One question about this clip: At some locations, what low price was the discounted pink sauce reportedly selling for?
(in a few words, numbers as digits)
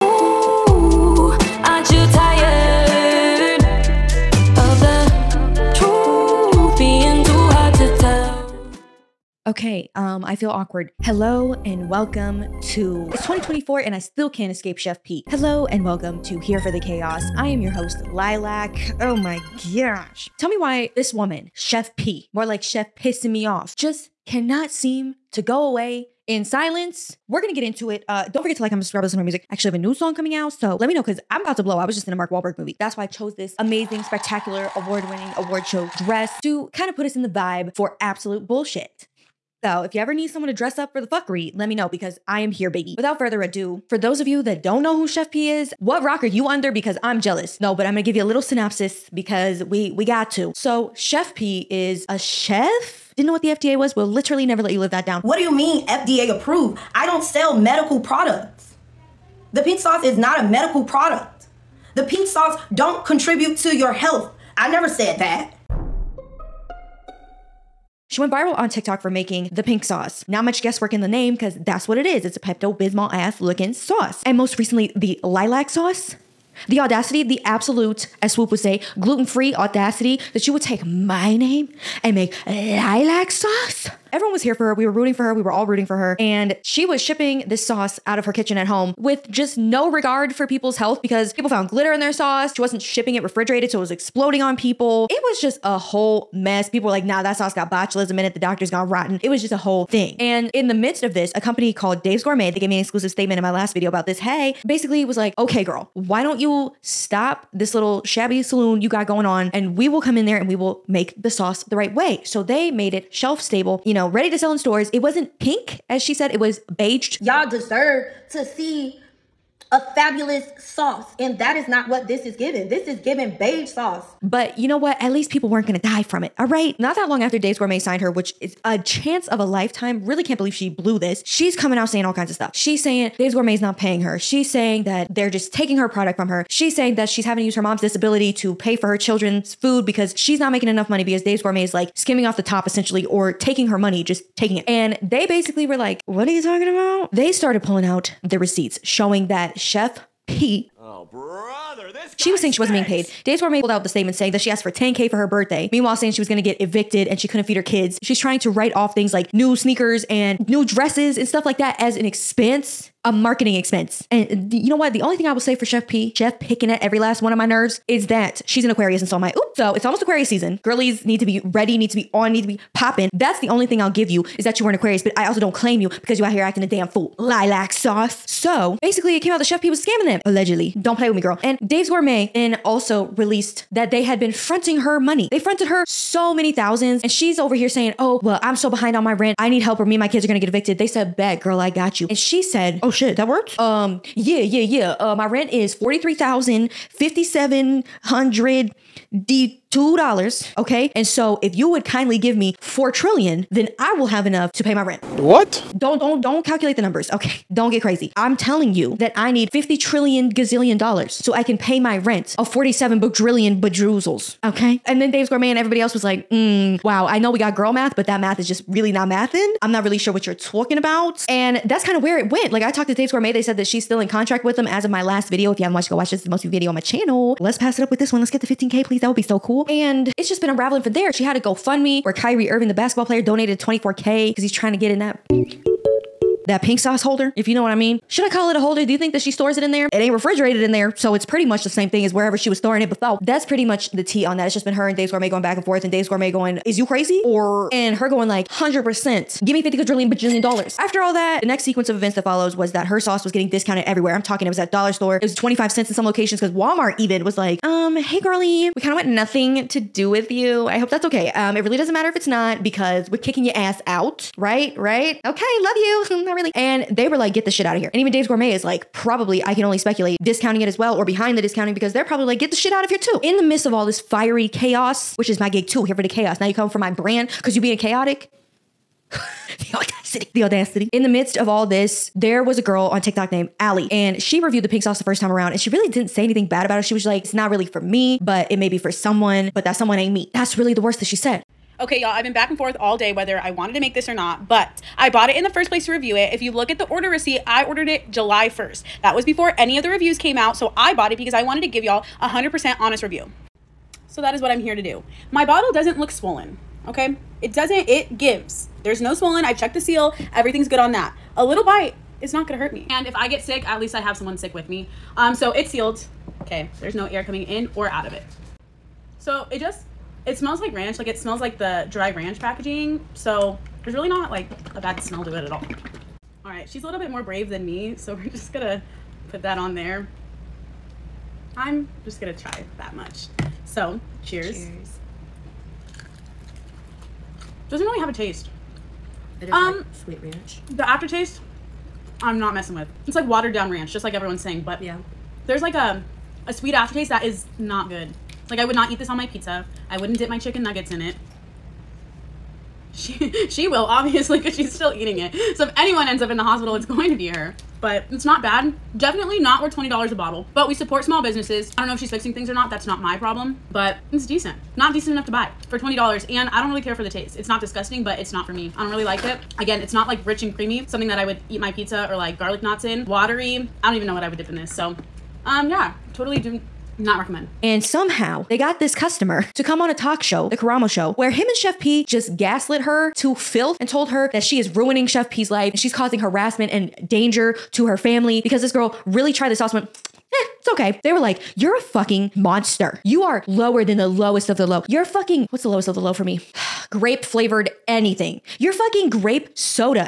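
25 cents.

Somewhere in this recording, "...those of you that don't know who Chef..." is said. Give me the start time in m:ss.
0:43.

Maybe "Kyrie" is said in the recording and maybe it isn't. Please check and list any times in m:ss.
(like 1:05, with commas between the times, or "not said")
3:52.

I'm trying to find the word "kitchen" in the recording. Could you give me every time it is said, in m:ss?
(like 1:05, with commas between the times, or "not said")
1:28.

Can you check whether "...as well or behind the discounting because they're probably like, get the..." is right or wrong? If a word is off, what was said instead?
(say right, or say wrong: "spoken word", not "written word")
right.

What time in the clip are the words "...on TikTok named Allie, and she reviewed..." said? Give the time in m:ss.
4:42.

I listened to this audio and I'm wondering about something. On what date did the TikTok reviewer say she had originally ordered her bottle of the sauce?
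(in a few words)
July 1st.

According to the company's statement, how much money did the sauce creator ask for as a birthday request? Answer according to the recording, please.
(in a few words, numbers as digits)
10K.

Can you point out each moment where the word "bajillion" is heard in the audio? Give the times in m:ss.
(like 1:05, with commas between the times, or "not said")
3:33, 4:10.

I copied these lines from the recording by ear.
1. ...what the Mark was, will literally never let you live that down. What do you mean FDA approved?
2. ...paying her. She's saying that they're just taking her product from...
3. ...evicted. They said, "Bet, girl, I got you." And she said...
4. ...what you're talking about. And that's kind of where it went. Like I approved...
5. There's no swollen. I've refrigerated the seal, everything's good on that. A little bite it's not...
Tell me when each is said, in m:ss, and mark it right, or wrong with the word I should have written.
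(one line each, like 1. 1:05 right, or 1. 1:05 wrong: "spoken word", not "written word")
1. 0:53 wrong: "FDA", not "Mark"
2. 2:13 right
3. 3:10 right
4. 3:40 wrong: "talked", not "approved"
5. 5:08 wrong: "checked", not "refrigerated".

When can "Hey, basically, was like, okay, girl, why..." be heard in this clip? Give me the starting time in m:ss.
1:44.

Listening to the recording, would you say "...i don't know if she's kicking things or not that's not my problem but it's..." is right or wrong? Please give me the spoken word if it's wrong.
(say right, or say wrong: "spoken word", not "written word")
wrong: "fixing", not "kicking".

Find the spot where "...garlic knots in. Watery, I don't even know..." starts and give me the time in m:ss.
6:12.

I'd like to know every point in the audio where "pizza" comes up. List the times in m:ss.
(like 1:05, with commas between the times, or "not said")
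5:49, 6:11.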